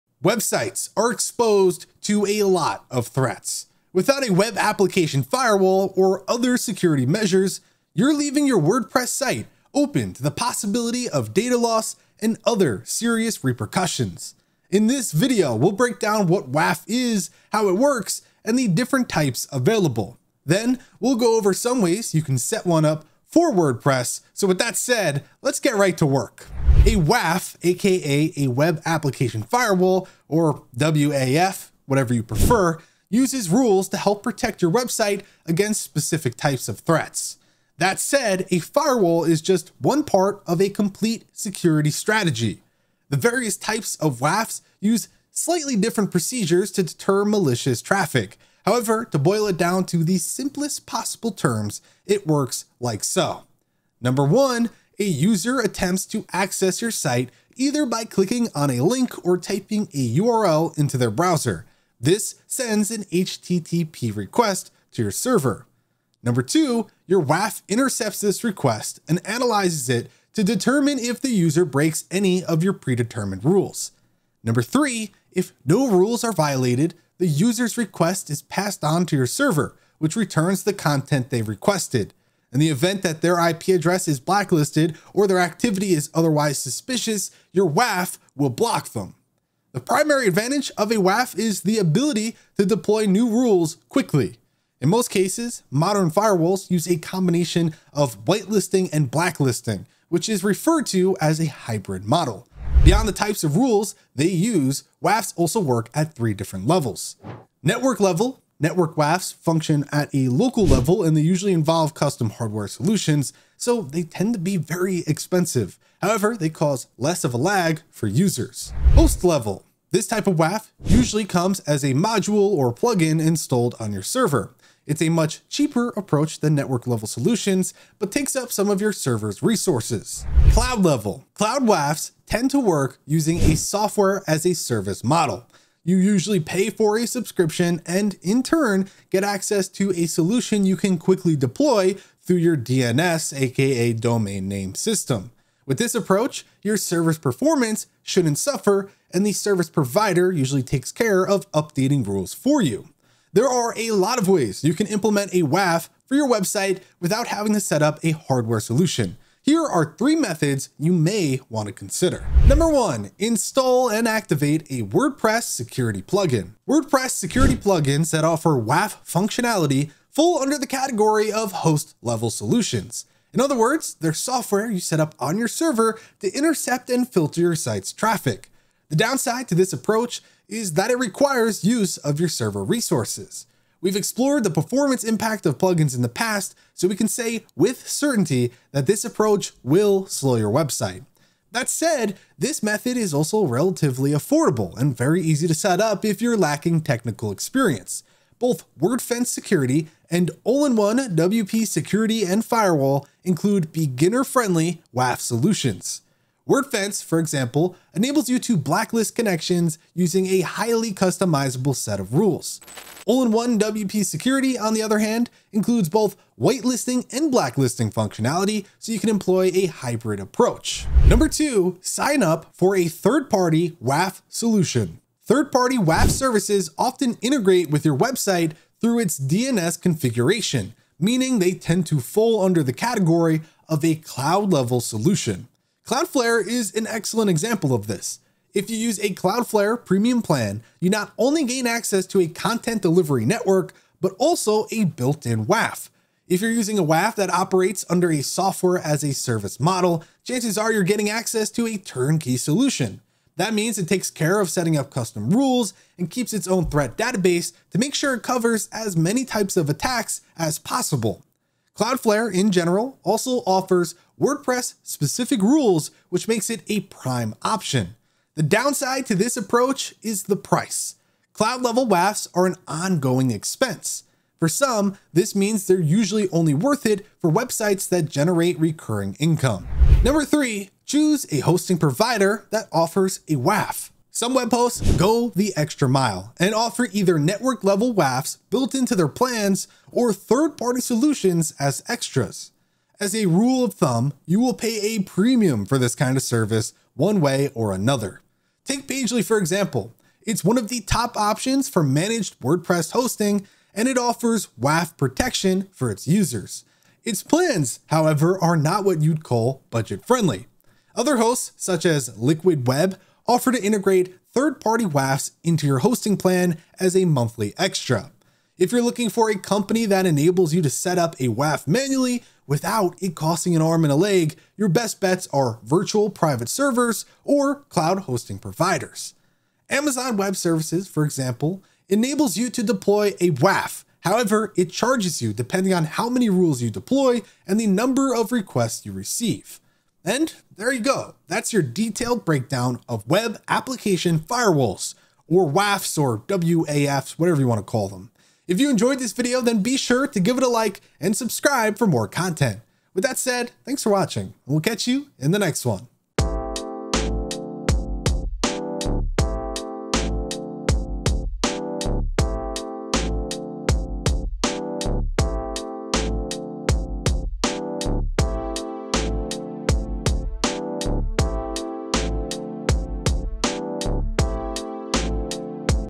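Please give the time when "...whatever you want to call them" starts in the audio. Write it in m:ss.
5:47.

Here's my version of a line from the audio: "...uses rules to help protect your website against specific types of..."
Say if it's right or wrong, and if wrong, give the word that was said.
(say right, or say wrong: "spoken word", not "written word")
right.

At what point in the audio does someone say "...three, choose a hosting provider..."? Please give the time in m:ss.
4:40.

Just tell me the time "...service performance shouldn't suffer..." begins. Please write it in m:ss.
2:26.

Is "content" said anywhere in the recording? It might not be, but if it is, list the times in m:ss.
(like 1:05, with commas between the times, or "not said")
1:20, 4:02, 5:52.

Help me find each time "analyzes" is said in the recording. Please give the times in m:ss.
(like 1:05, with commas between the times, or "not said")
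1:09.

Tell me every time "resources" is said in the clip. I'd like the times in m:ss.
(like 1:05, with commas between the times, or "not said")
2:09, 3:02.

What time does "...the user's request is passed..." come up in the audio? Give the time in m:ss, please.
1:17.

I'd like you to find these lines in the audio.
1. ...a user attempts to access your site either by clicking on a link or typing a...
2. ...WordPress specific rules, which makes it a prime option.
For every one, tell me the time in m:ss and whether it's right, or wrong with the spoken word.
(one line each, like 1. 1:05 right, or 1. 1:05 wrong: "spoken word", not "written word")
1. 0:54 right
2. 4:24 right.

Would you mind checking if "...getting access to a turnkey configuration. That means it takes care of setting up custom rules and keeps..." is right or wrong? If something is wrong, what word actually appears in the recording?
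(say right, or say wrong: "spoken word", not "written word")
wrong: "solution", not "configuration".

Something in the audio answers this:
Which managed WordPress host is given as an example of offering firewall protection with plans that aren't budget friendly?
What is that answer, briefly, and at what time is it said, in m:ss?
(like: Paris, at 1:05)
Pagely, at 4:58.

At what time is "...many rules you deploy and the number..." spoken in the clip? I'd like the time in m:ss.
5:36.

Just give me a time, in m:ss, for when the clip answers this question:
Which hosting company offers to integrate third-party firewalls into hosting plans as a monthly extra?
5:12.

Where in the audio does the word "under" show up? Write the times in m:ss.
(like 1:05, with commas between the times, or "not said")
2:50, 3:52, 4:07.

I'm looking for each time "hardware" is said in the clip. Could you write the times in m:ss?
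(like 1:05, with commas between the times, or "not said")
1:52, 2:38.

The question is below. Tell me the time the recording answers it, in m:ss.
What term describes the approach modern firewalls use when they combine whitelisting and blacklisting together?
1:41.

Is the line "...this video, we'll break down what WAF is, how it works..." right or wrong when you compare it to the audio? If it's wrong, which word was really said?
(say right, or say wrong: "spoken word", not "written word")
right.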